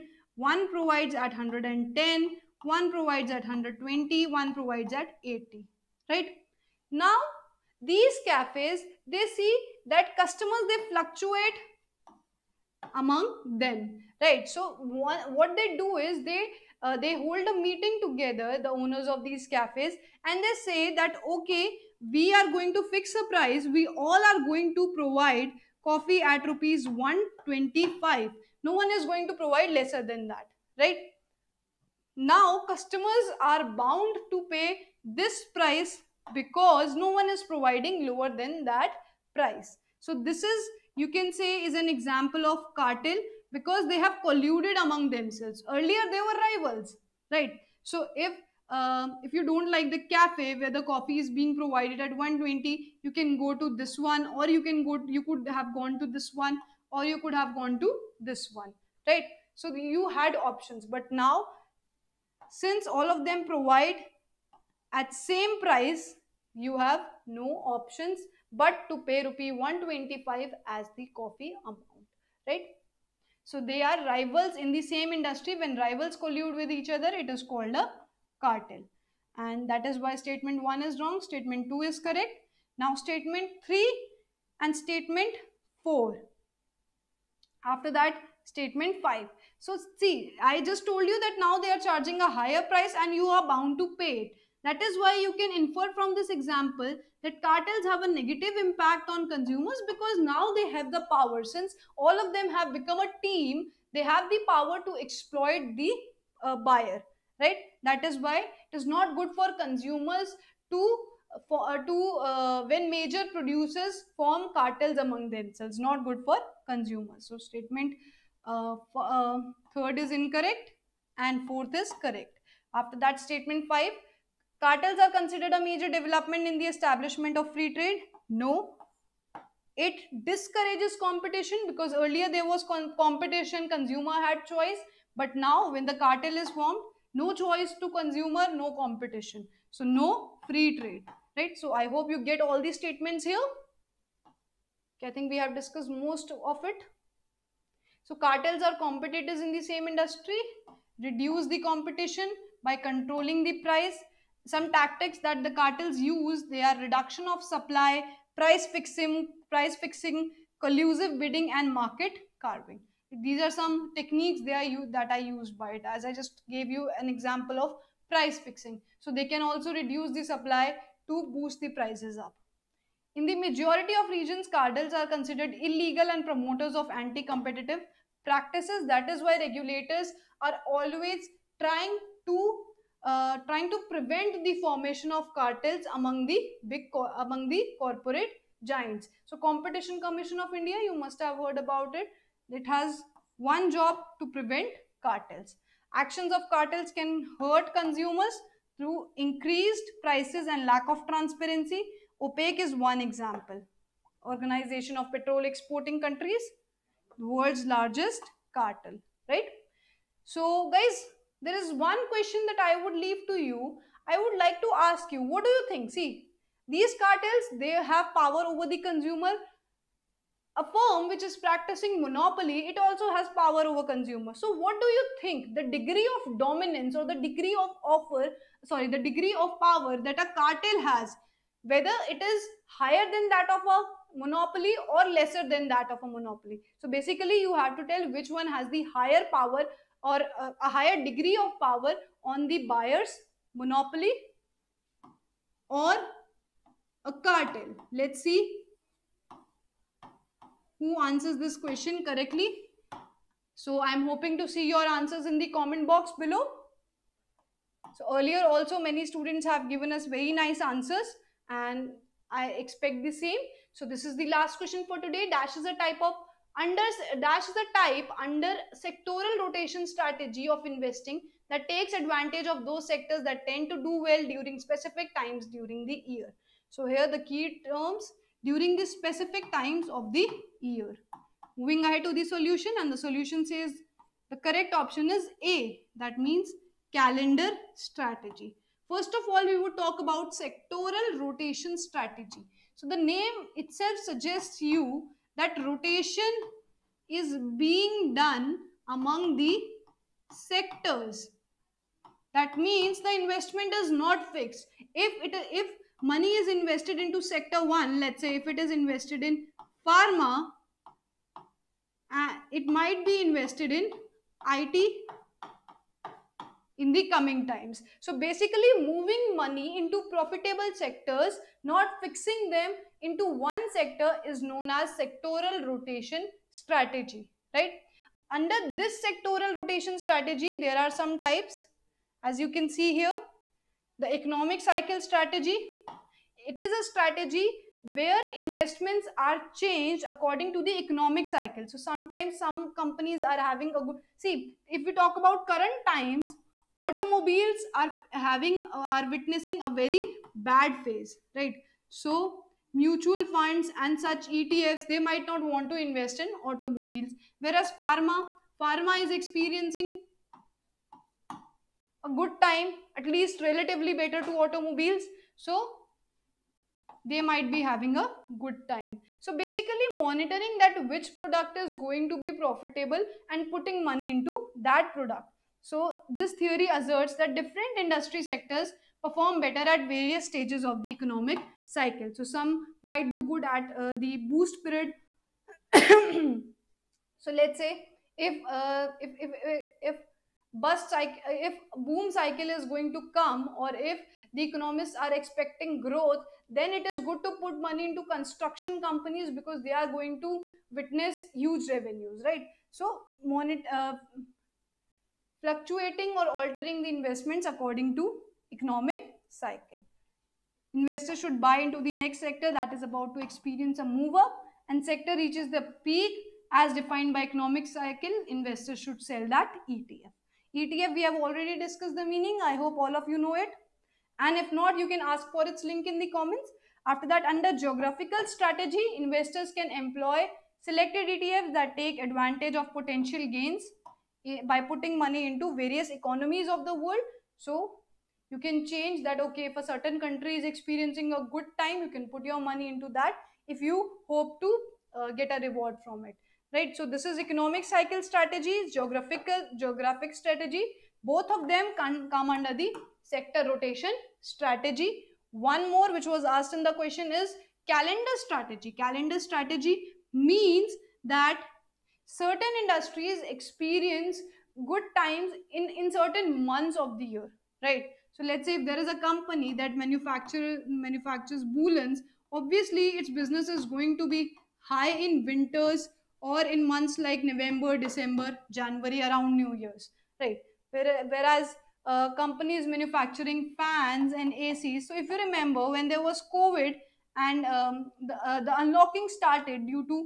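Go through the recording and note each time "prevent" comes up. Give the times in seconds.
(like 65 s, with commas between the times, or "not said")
183 s, 194 s.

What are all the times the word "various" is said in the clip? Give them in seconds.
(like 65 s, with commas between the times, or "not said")
379 s, 435 s.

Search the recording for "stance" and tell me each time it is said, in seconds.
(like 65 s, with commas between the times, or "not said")
not said.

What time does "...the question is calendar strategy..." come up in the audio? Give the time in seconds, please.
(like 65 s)
456 s.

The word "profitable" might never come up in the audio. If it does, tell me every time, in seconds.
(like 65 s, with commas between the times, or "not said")
320 s, 372 s.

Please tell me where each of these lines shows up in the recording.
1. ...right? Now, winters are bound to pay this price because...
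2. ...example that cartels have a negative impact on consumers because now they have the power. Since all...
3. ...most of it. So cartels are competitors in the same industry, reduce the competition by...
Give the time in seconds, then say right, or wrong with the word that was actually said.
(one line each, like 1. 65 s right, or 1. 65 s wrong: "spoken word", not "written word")
1. 30 s wrong: "customers", not "winters"
2. 96 s right
3. 145 s right.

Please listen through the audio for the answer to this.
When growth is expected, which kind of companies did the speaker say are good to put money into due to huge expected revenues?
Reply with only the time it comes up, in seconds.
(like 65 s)
398 s.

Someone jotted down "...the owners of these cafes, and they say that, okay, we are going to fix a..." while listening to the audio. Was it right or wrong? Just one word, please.
right.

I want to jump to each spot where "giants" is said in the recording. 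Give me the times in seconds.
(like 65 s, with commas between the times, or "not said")
188 s.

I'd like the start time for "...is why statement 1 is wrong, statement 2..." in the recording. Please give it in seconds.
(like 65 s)
79 s.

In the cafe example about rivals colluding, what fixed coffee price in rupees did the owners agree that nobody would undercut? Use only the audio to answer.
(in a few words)
125.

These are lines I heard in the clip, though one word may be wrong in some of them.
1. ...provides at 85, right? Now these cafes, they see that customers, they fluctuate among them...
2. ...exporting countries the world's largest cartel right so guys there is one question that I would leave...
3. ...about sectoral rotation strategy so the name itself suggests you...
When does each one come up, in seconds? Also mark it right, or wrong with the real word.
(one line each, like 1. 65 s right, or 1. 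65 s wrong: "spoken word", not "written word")
1. 4 s wrong: "80", not "85"
2. 205 s right
3. 289 s right.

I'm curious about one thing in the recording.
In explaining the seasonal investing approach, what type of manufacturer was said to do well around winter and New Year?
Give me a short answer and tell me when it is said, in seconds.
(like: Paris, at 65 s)
Woolens, at 471 s.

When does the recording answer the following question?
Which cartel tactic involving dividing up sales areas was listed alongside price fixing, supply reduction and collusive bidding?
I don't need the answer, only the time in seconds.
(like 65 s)
161 s.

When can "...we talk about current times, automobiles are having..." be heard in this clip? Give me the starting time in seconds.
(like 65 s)
344 s.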